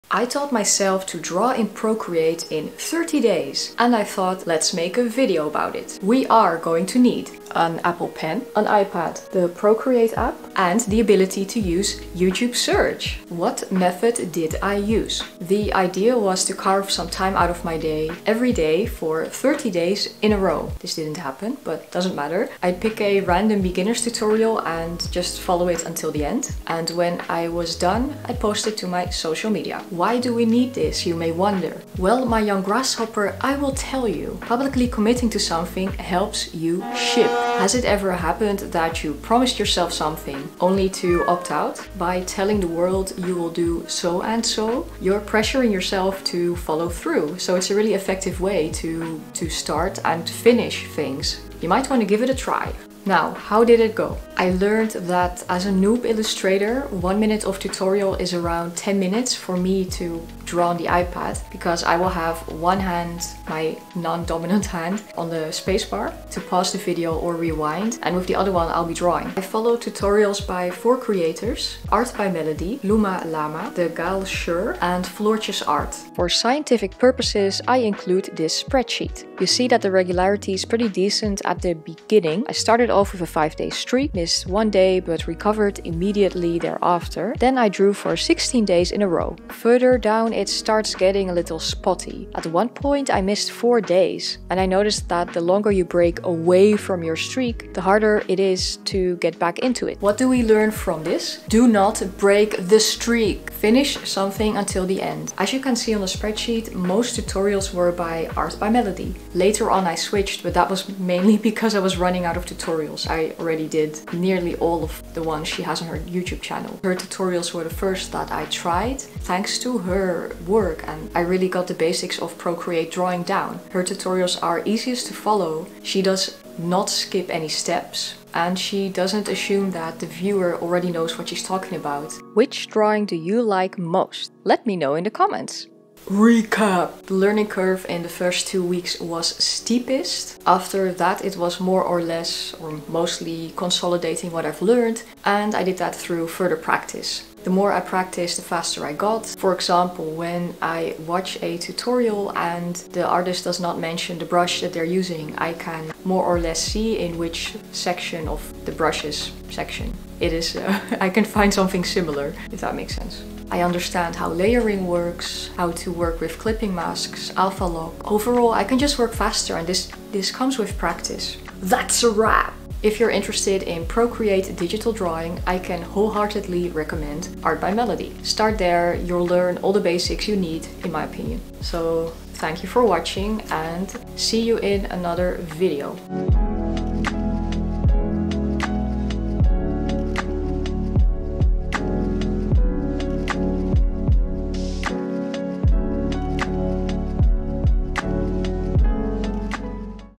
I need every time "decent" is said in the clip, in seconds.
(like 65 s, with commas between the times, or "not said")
80 s.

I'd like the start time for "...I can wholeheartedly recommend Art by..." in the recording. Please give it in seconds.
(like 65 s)
175 s.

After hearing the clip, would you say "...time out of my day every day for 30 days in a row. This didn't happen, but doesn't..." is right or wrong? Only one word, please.
right.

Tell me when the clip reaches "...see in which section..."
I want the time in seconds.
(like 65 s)
156 s.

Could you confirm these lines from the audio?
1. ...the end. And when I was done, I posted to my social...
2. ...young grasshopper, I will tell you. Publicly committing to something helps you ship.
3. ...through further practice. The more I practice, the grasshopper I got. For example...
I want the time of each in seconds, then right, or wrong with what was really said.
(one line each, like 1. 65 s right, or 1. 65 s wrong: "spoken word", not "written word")
1. 26 s right
2. 32 s right
3. 145 s wrong: "faster", not "grasshopper".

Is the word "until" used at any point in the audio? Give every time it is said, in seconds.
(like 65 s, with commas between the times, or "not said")
25 s, 104 s.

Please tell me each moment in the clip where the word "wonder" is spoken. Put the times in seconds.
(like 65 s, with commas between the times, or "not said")
31 s.